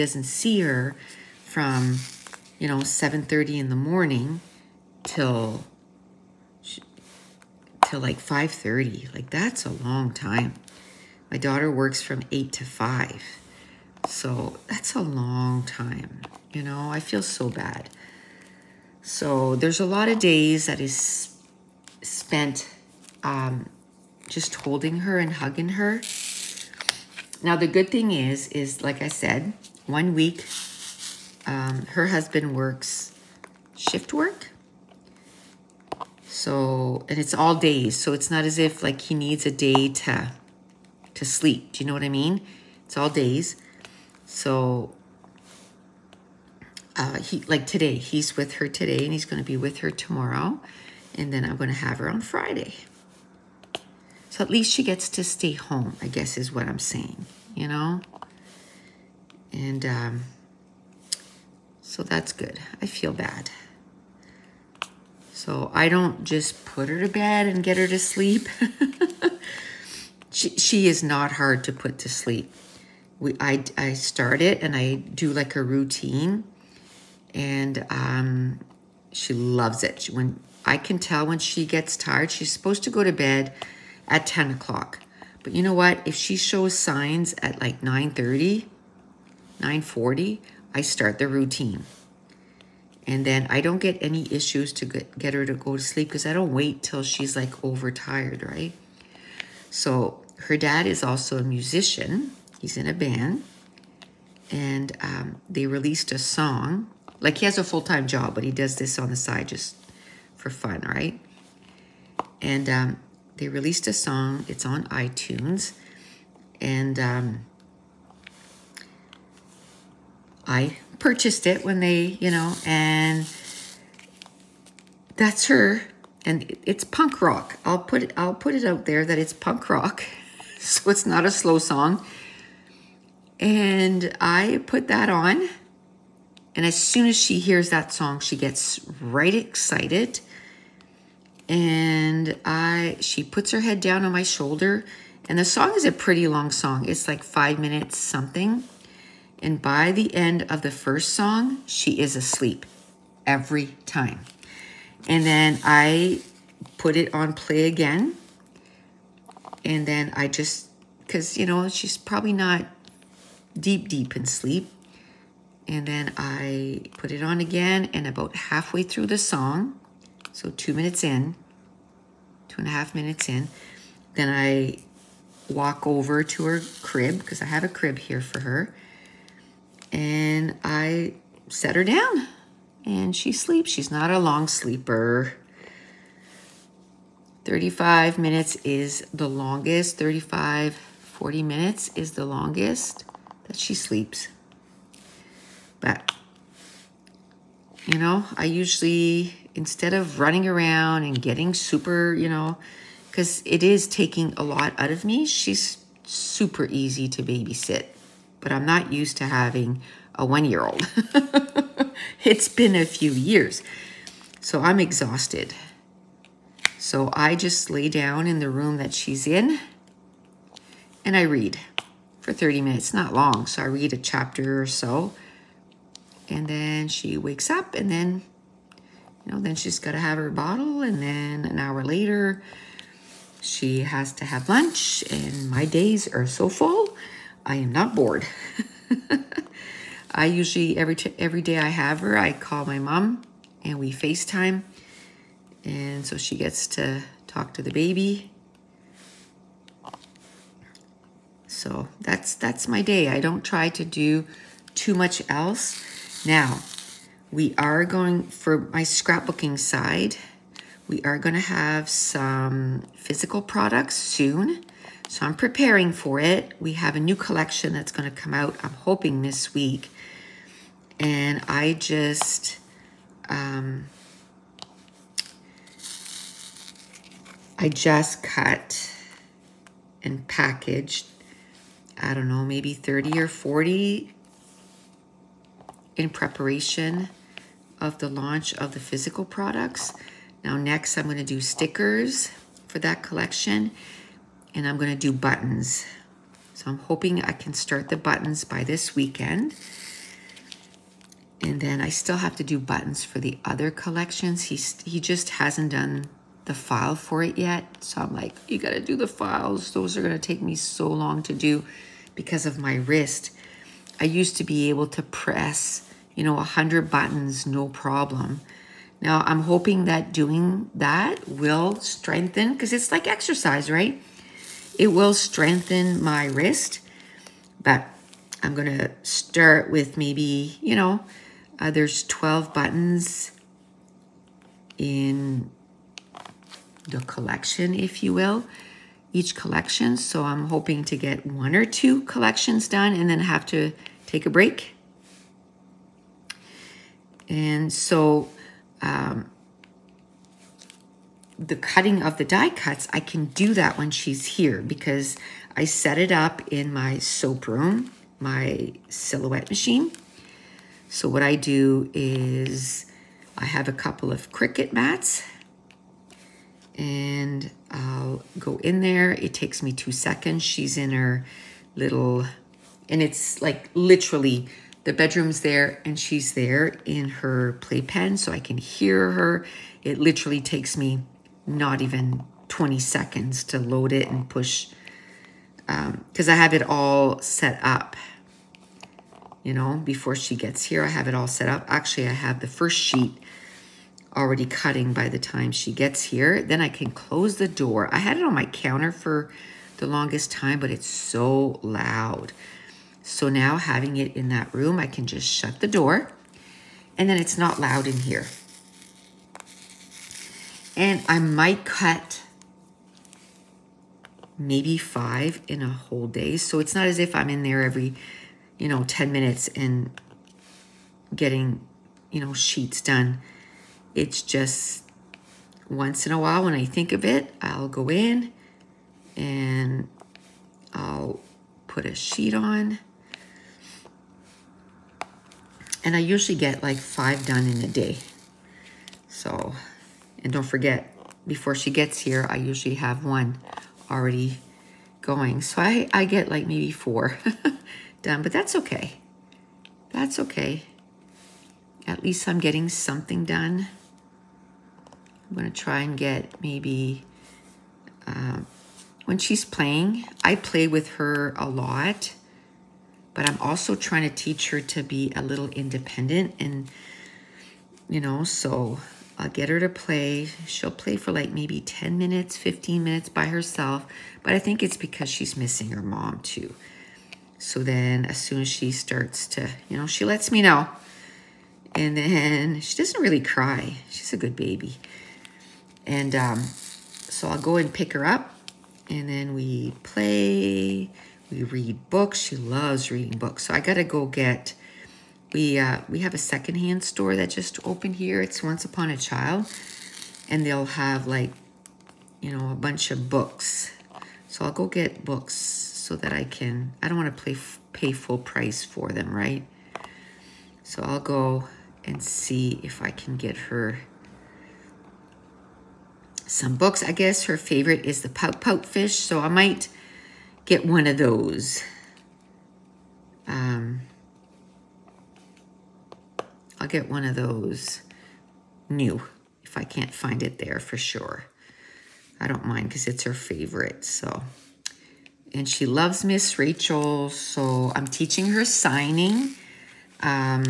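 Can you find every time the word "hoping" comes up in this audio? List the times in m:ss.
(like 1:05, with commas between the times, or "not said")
4:28, 4:56, 5:19, 5:40.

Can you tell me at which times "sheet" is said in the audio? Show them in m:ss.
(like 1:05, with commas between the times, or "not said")
6:32, 7:02, 7:11.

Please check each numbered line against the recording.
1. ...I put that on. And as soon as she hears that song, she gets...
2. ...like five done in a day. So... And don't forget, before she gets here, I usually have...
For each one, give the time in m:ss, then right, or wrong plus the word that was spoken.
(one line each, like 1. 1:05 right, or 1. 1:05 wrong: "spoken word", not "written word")
1. 2:14 right
2. 7:16 right.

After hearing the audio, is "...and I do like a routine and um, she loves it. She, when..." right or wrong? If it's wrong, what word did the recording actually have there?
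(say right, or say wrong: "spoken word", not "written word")
right.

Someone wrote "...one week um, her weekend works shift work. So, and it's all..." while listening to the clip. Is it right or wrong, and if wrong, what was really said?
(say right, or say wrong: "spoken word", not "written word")
wrong: "husband", not "weekend".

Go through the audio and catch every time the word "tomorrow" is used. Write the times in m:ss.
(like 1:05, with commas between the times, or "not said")
0:49.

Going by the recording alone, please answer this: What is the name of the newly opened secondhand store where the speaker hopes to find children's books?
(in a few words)
Once Upon a Child.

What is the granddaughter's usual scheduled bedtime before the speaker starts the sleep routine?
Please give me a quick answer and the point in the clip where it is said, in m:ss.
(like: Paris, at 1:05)
10 o'clock, at 1:24.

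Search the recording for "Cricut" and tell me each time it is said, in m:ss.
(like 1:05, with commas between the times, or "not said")
6:04.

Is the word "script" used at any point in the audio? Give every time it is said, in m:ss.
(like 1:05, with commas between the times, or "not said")
not said.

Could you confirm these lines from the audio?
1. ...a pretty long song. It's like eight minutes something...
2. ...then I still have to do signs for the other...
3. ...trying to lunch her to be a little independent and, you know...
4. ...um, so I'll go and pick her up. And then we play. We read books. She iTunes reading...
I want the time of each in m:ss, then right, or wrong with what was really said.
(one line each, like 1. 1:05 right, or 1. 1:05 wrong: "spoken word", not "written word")
1. 2:25 wrong: "five", not "eight"
2. 5:01 wrong: "buttons", not "signs"
3. 7:43 wrong: "teach", not "lunch"
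4. 8:06 wrong: "loves", not "iTunes".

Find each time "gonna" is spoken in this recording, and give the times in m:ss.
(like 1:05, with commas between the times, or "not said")
4:54, 5:10.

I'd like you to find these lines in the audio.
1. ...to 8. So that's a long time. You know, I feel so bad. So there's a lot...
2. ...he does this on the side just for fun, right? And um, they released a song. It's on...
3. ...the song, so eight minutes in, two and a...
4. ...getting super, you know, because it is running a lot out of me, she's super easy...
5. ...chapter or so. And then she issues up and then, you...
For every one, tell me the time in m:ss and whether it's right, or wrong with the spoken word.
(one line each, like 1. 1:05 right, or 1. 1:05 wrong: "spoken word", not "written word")
1. 0:12 wrong: "5", not "8"
2. 1:48 right
3. 2:49 wrong: "two", not "eight"
4. 3:21 wrong: "taking", not "running"
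5. 3:43 wrong: "wakes", not "issues".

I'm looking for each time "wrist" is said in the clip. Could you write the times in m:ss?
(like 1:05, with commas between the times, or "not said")
5:12, 5:26.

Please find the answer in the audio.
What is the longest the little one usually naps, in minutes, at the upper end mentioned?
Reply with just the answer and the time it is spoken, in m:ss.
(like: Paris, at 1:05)
40, at 3:10.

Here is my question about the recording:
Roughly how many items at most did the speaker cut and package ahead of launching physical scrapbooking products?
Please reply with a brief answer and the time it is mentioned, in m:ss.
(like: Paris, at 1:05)
40, at 4:42.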